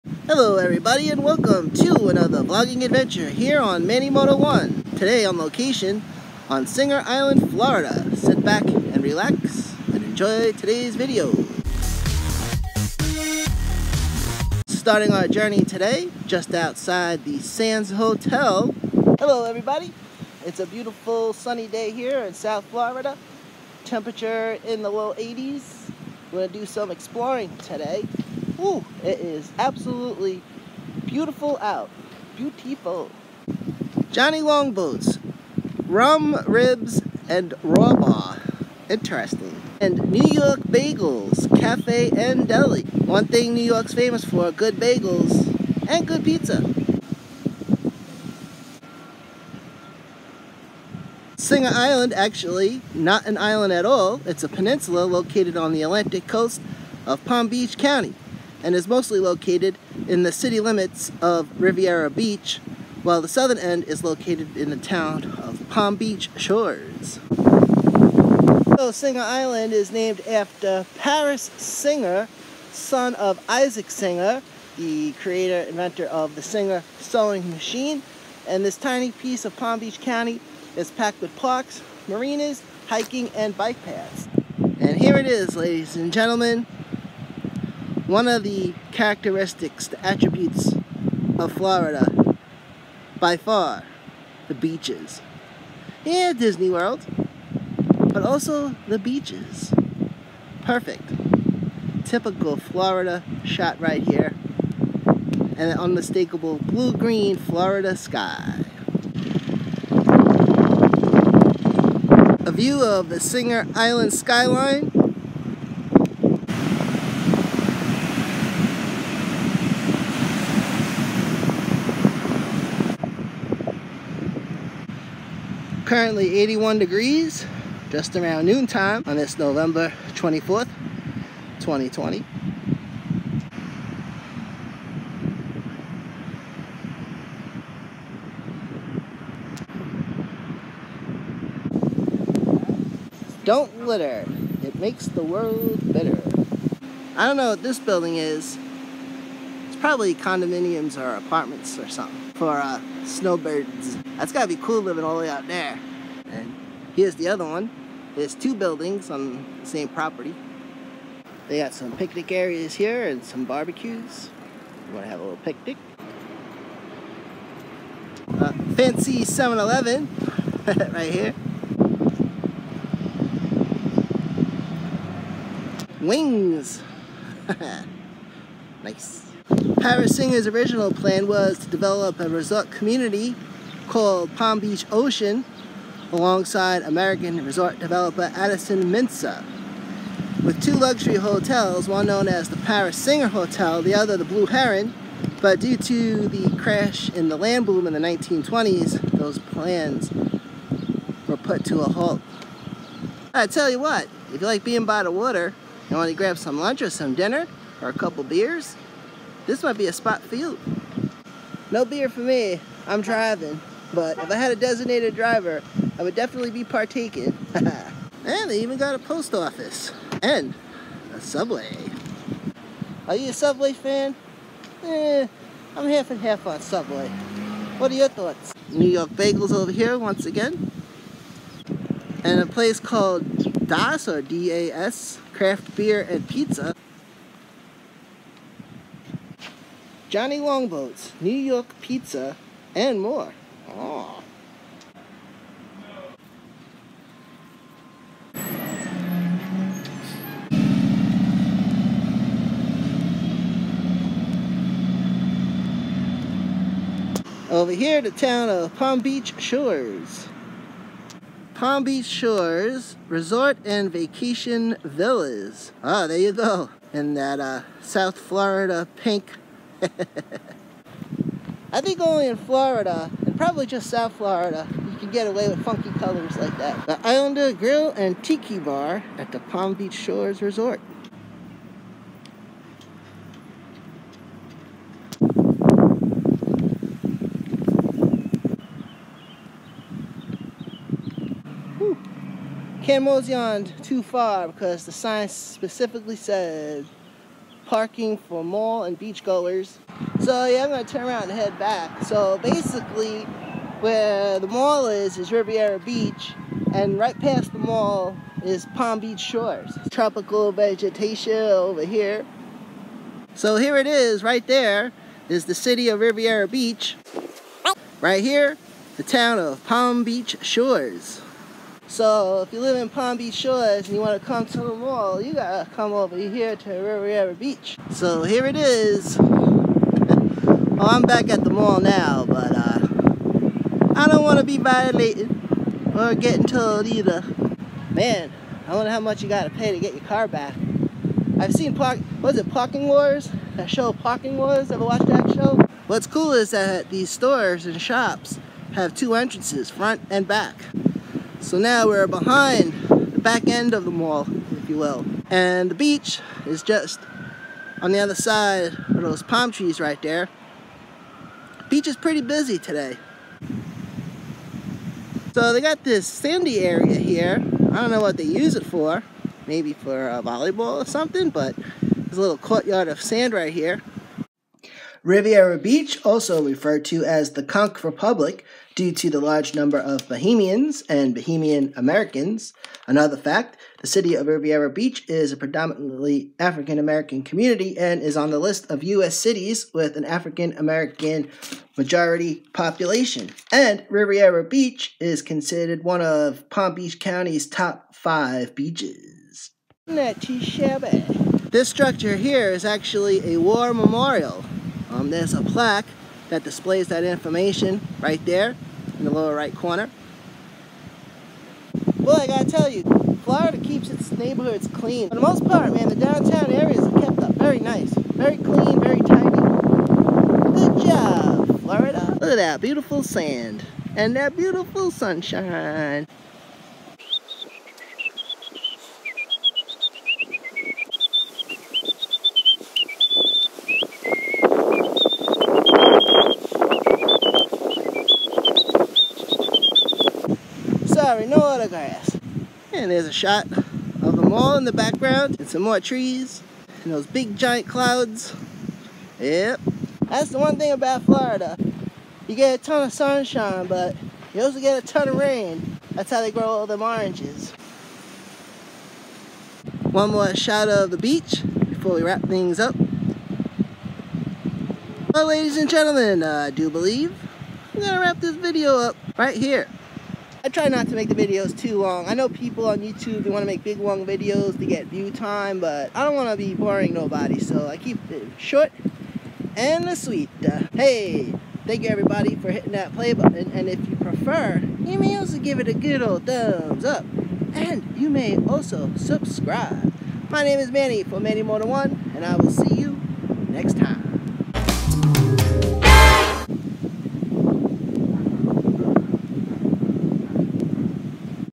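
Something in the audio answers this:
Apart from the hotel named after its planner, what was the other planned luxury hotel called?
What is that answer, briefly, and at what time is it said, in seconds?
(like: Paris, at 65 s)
Blue Heron, at 194 s.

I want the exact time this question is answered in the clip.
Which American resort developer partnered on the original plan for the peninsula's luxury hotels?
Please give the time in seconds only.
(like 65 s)
188 s.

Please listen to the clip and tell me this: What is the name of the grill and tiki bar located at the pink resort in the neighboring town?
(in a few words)
The Islander Grill.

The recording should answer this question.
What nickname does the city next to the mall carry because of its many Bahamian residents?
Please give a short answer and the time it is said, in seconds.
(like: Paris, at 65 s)
Conch Republic, at 377 s.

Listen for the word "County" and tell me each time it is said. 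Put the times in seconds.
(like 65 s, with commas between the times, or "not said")
57 s, 79 s, 396 s.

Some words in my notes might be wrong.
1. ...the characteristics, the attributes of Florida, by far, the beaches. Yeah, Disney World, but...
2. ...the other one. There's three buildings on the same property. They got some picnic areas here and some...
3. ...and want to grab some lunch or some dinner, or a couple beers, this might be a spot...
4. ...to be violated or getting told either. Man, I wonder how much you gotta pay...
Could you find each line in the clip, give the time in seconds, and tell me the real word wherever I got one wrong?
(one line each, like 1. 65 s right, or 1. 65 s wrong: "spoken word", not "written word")
1. 88 s right
2. 157 s wrong: "two", not "three"
3. 205 s right
4. 334 s right.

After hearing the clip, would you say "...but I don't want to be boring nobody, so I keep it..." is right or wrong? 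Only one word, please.
right.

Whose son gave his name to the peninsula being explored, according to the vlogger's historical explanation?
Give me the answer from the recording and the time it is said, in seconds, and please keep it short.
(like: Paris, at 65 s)
Isaac Singer, at 73 s.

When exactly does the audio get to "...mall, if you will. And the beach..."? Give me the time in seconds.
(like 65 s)
353 s.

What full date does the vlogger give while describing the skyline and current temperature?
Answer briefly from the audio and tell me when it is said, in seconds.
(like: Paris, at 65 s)
November 24th, 2020, at 129 s.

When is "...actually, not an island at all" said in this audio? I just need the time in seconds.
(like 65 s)
52 s.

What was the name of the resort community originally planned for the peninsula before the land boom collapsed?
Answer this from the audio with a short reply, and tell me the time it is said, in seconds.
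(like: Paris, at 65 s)
Palm Beach Ocean, at 184 s.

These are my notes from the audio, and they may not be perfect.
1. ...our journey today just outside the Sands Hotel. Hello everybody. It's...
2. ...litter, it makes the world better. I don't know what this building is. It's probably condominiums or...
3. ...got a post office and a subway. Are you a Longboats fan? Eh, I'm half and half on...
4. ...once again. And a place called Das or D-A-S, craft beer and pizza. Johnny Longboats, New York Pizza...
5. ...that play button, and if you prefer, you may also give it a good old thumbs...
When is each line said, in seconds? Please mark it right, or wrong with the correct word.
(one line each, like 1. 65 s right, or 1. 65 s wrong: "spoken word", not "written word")
1. 15 s right
2. 143 s right
3. 218 s wrong: "Subway", not "Longboats"
4. 229 s right
5. 482 s right.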